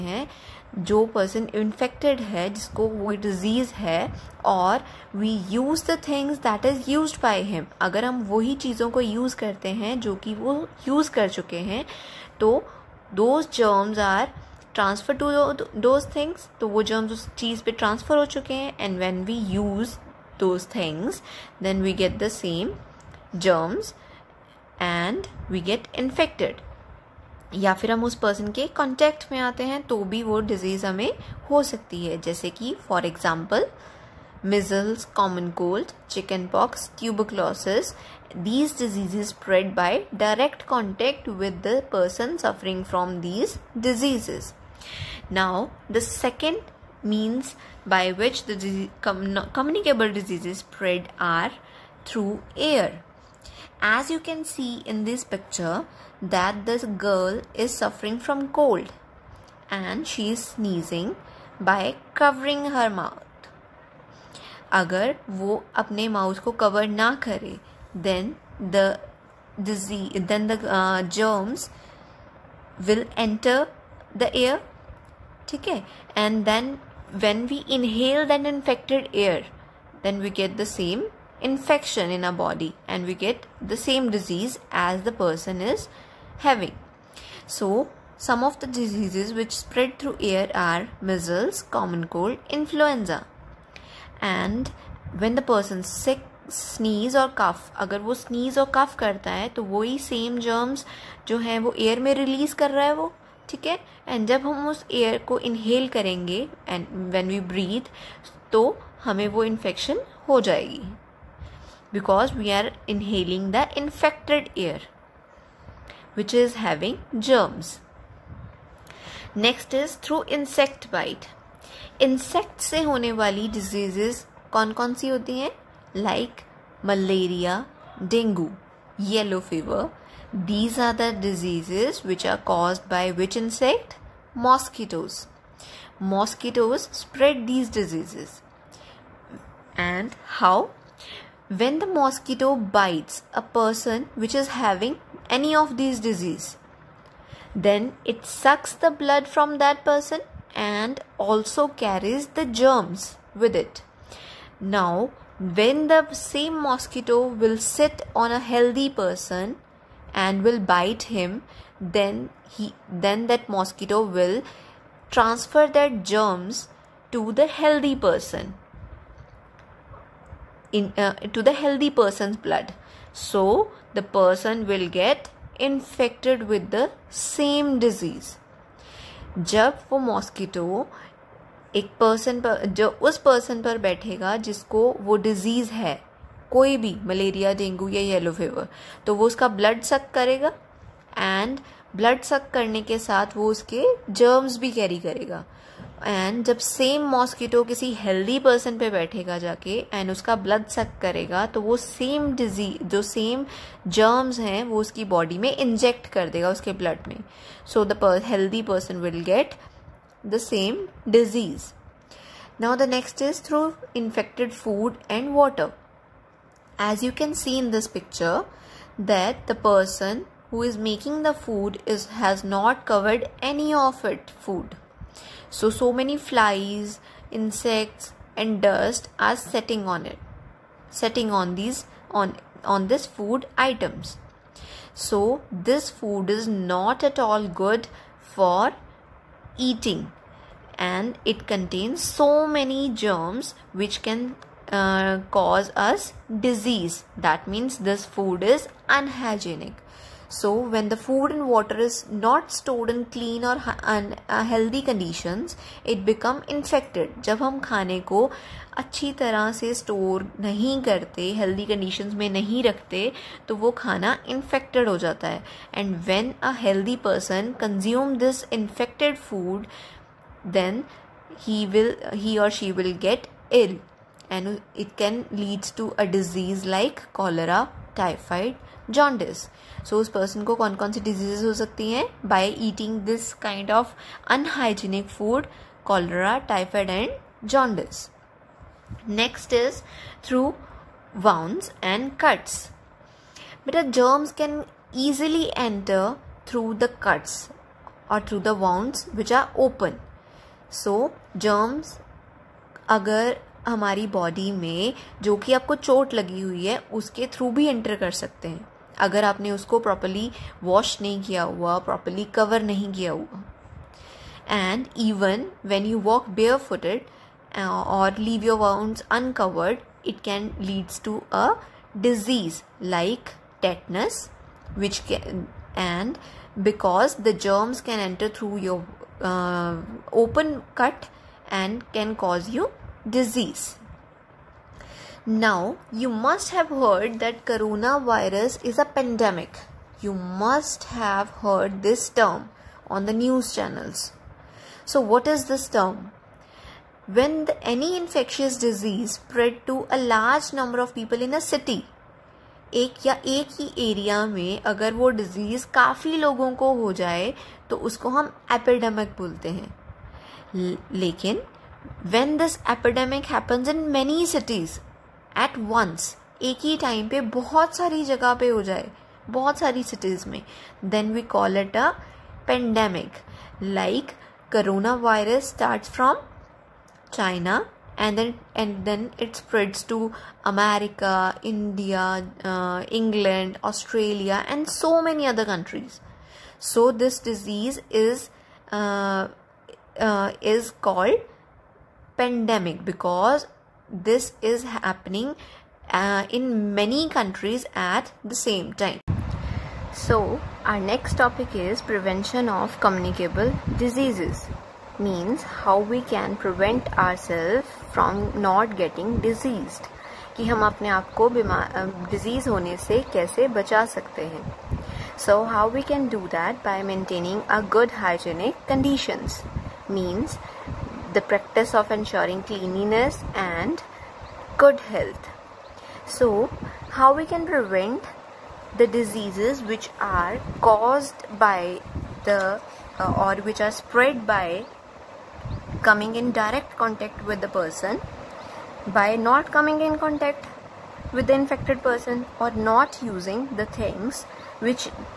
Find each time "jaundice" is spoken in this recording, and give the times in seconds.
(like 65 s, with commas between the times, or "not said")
278 s, 287 s.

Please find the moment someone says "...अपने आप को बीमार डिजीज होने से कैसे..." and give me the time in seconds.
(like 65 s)
410 s.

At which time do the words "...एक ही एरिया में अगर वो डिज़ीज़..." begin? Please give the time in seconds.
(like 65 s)
353 s.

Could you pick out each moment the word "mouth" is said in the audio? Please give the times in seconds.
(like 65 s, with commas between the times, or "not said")
62 s.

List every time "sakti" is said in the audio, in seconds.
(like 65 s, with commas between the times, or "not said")
281 s.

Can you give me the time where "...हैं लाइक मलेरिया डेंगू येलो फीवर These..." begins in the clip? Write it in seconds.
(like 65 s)
125 s.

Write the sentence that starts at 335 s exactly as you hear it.
Now, you must have heard that coronavirus is a pandemic.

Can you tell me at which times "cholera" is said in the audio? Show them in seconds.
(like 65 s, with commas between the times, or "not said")
277 s, 285 s.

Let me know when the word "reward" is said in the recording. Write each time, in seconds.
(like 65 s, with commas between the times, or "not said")
not said.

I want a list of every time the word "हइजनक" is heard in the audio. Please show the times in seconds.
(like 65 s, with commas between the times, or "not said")
418 s.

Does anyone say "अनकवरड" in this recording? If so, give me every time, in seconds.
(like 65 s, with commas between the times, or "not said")
319 s.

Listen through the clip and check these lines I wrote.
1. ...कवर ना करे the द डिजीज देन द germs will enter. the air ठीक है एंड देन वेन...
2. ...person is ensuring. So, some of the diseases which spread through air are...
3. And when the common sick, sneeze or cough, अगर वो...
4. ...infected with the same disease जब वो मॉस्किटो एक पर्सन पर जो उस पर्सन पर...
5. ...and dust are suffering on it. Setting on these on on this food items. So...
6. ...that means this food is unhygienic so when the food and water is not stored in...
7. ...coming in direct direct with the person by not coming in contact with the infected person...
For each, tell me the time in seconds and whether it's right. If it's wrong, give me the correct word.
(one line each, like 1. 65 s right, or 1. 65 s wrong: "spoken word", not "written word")
1. 66 s right
2. 85 s wrong: "having", not "ensuring"
3. 94 s wrong: "person", not "common"
4. 175 s right
5. 228 s wrong: "setting", not "suffering"
6. 247 s right
7. 435 s wrong: "contact", not "direct".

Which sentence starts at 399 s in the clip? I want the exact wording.
So, our next topic is prevention of communicable diseases.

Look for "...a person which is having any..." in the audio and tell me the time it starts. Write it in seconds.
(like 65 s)
143 s.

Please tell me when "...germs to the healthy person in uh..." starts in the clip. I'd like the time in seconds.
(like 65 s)
165 s.